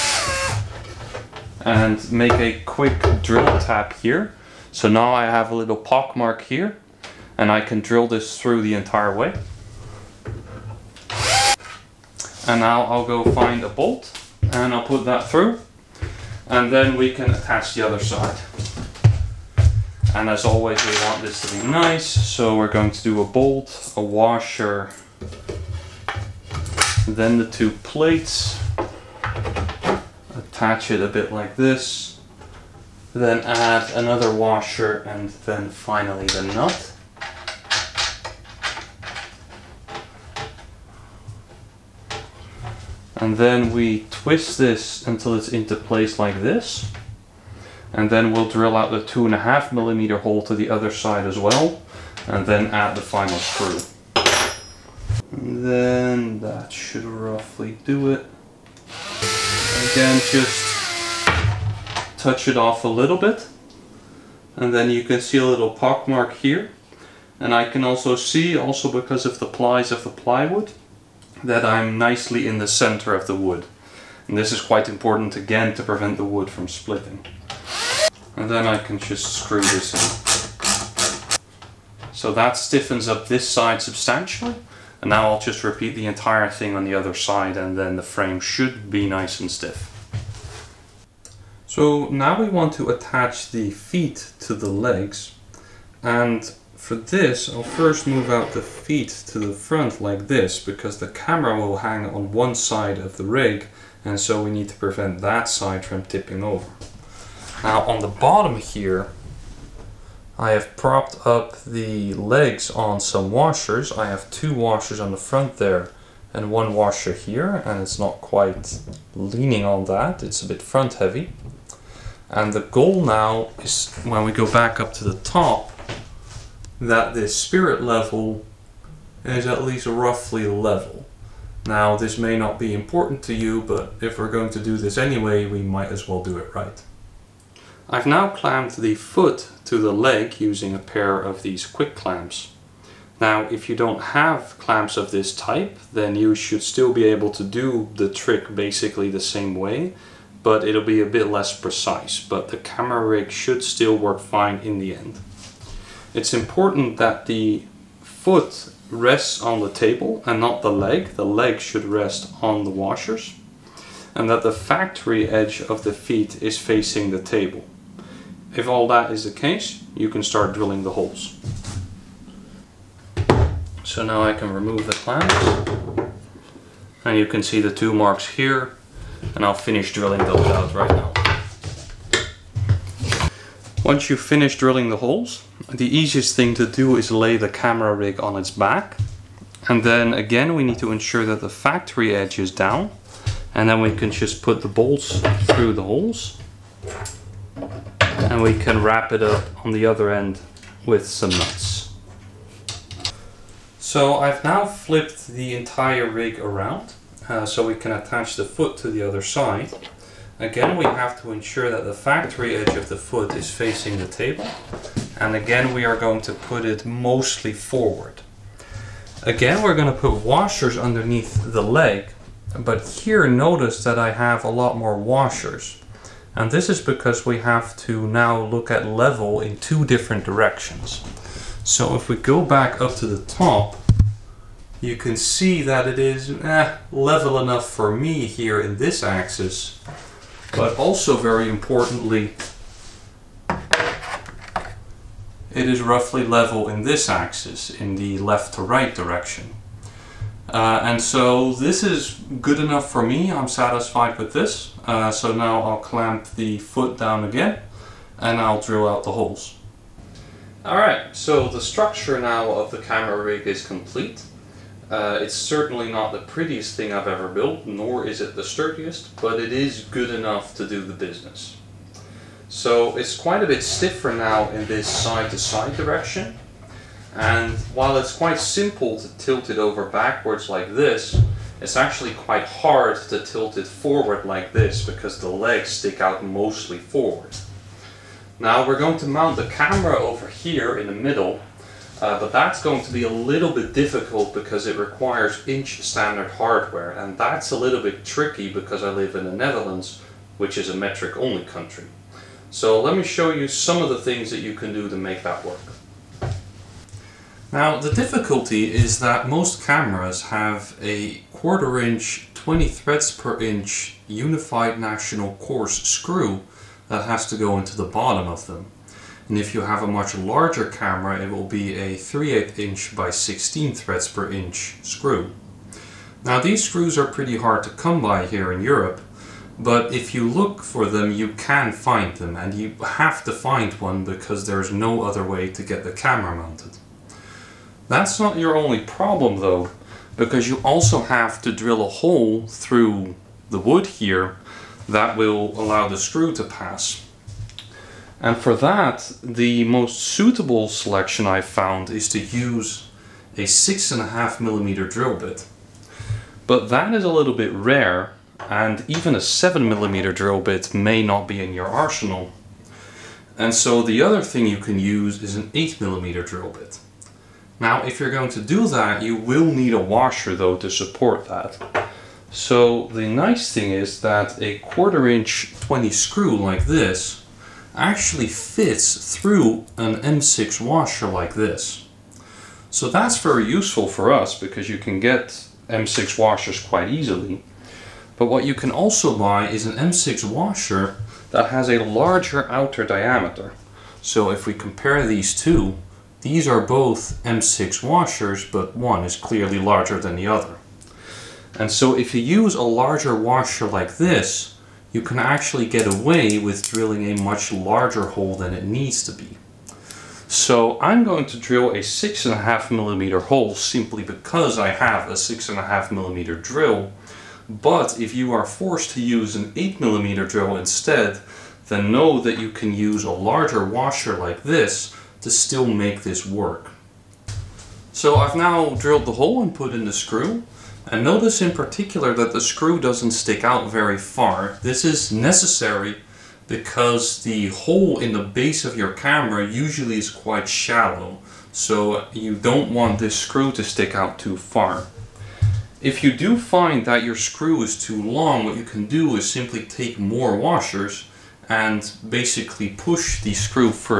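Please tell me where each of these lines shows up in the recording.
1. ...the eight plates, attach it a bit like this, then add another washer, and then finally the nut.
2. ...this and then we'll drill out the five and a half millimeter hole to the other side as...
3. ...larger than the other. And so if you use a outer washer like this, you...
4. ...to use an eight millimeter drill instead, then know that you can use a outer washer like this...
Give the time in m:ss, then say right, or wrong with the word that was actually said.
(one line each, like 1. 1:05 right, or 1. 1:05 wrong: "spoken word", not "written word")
1. 0:27 wrong: "two", not "eight"
2. 0:46 wrong: "two", not "five"
3. 6:39 wrong: "larger", not "outer"
4. 6:58 wrong: "larger", not "outer".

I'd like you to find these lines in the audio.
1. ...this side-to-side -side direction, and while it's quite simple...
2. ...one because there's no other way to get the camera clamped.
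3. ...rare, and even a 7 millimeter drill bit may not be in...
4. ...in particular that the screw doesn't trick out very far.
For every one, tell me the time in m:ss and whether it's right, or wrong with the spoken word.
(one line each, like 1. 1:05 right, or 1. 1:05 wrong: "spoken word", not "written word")
1. 4:34 right
2. 5:33 wrong: "mounted", not "clamped"
3. 5:57 right
4. 7:11 wrong: "stick", not "trick".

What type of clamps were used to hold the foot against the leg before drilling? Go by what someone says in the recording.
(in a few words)
quick clamps.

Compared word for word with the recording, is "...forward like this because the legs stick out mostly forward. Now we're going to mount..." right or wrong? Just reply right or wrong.
right.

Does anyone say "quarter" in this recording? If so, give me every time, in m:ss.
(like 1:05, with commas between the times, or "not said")
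5:11, 6:14.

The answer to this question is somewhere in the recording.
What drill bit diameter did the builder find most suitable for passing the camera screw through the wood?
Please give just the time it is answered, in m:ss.
5:53.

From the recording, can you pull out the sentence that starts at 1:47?
Now on the bottom here, I have propped up the legs on some washers.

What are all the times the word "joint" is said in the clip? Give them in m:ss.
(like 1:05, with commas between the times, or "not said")
not said.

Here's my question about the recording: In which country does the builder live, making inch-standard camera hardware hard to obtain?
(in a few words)
the Netherlands.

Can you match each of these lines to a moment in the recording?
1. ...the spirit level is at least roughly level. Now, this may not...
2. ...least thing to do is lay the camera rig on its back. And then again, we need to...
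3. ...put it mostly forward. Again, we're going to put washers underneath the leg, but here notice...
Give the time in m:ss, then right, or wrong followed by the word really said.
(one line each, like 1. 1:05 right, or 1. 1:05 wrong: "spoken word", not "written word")
1. 2:07 right
2. 3:05 wrong: "easiest", not "least"
3. 3:36 right.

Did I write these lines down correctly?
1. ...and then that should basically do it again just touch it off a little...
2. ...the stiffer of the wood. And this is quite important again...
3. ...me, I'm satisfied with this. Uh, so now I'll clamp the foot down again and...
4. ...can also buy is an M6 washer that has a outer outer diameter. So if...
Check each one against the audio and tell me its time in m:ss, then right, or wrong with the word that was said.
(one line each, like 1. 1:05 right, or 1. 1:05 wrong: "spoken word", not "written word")
1. 0:55 wrong: "roughly", not "basically"
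2. 1:12 wrong: "center", not "stiffer"
3. 4:13 right
4. 6:28 wrong: "larger", not "outer".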